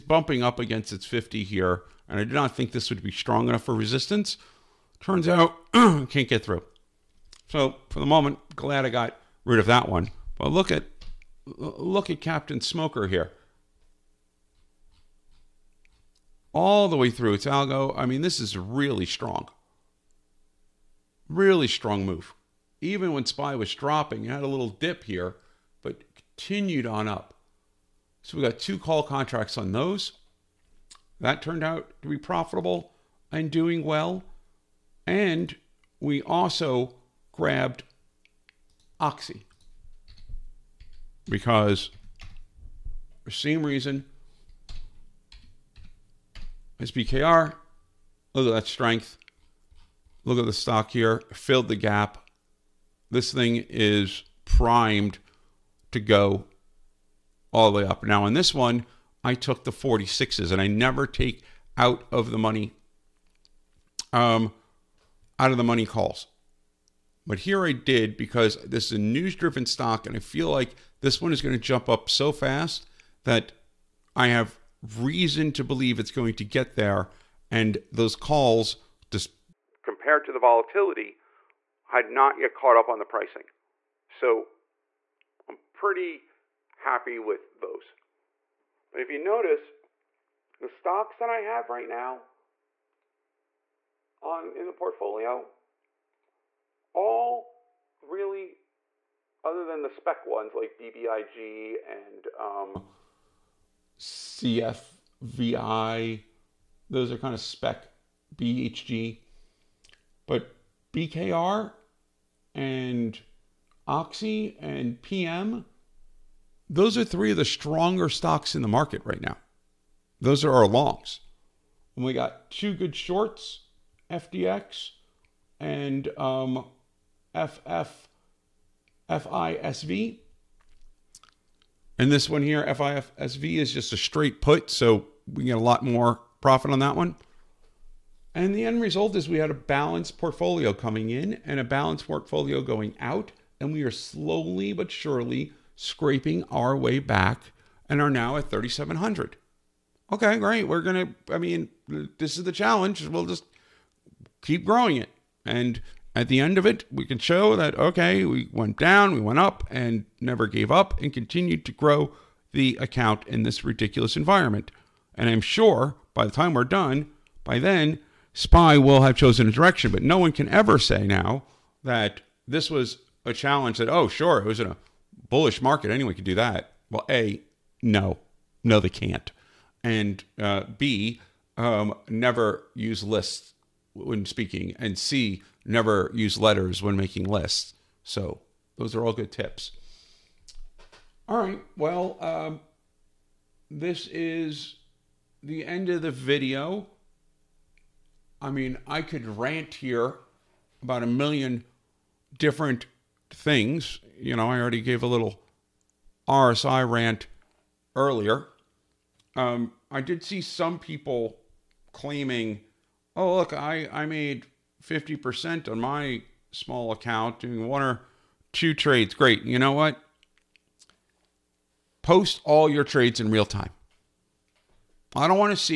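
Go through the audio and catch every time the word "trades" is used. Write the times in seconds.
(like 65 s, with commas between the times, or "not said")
218 s, 222 s.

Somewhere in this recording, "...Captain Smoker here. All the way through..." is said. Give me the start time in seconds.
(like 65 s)
12 s.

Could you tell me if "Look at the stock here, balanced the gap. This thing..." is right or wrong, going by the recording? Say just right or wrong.
wrong.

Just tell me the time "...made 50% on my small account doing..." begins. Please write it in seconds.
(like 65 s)
214 s.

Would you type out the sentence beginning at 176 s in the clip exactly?
Well, A, no, no, they can't.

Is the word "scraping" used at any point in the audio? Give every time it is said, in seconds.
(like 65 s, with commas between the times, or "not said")
145 s.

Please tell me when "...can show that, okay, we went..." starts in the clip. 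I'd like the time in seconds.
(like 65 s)
157 s.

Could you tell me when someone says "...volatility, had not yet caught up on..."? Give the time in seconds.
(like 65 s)
80 s.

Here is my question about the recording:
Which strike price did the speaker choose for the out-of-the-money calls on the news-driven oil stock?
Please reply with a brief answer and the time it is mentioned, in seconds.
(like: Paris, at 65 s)
46, at 59 s.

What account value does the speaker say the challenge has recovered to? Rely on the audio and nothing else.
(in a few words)
3,700.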